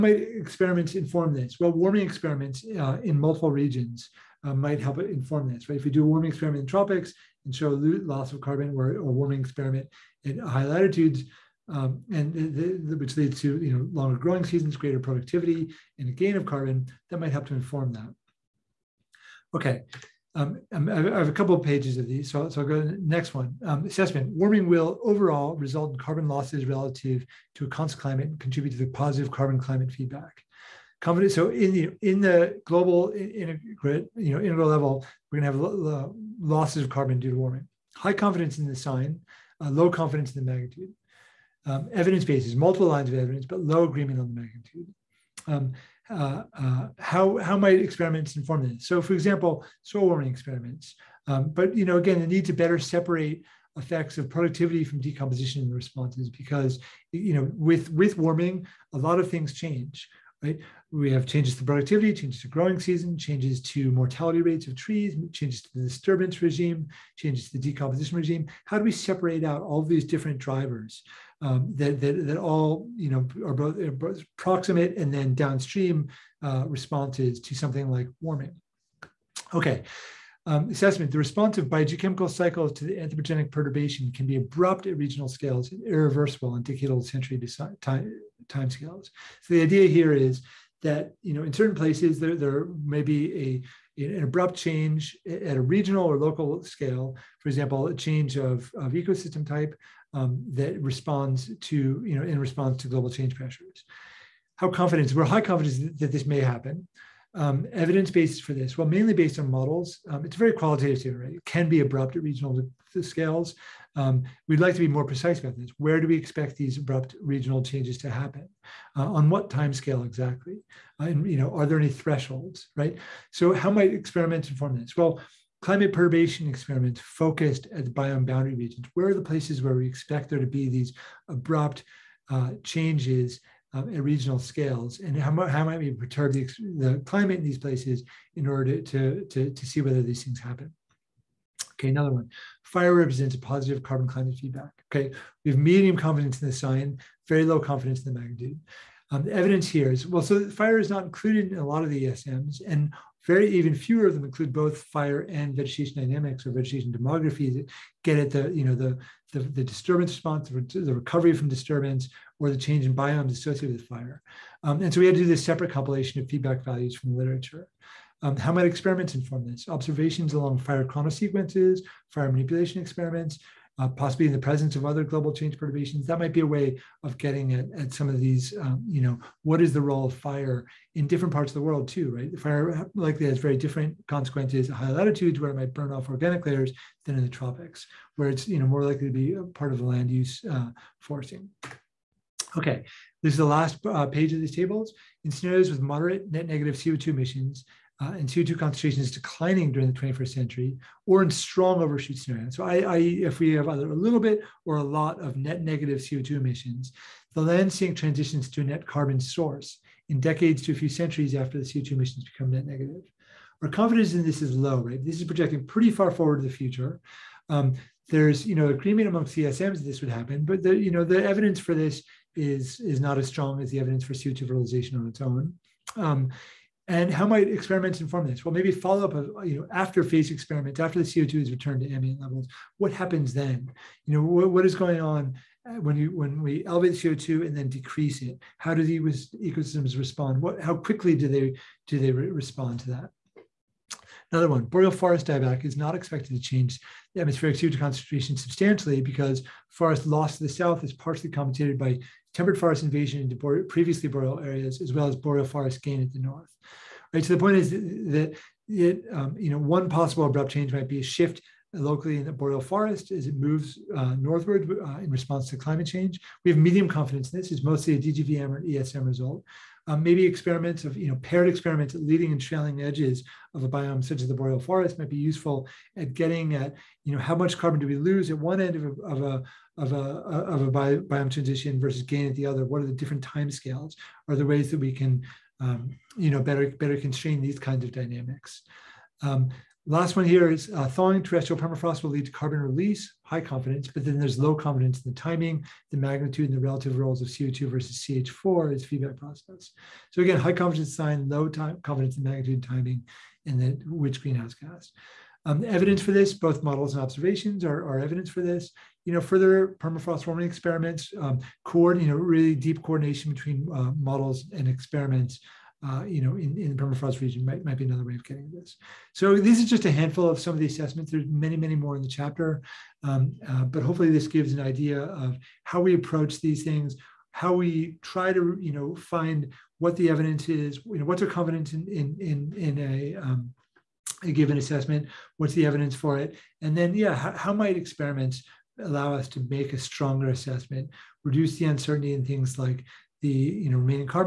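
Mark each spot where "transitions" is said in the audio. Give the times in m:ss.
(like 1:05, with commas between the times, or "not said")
3:27, 4:41.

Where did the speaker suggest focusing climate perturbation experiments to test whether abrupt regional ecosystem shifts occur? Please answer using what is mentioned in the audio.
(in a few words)
Biome boundary regions.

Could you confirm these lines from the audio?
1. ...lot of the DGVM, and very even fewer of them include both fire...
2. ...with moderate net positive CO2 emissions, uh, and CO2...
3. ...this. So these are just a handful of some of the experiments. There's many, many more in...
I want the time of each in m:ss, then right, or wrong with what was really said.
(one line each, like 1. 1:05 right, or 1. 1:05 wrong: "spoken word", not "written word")
1. 2:31 wrong: "ESMs", not "DGVM"
2. 3:15 wrong: "negative", not "positive"
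3. 5:18 wrong: "assessments", not "experiments".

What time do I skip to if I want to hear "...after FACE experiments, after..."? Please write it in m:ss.
3:49.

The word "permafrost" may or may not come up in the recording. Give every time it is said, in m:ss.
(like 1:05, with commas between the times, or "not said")
4:51, 5:09, 5:16.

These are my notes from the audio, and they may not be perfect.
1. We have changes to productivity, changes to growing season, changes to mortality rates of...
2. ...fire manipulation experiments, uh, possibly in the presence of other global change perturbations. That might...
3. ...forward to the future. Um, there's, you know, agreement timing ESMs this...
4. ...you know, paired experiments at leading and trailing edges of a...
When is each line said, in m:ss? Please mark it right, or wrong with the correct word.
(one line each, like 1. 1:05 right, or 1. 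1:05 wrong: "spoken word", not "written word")
1. 1:00 right
2. 2:52 right
3. 3:36 wrong: "among", not "timing"
4. 4:30 right.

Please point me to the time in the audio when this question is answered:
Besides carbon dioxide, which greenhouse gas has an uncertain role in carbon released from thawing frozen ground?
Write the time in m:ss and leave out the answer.
4:57.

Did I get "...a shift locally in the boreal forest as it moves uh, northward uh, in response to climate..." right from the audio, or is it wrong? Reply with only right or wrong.
right.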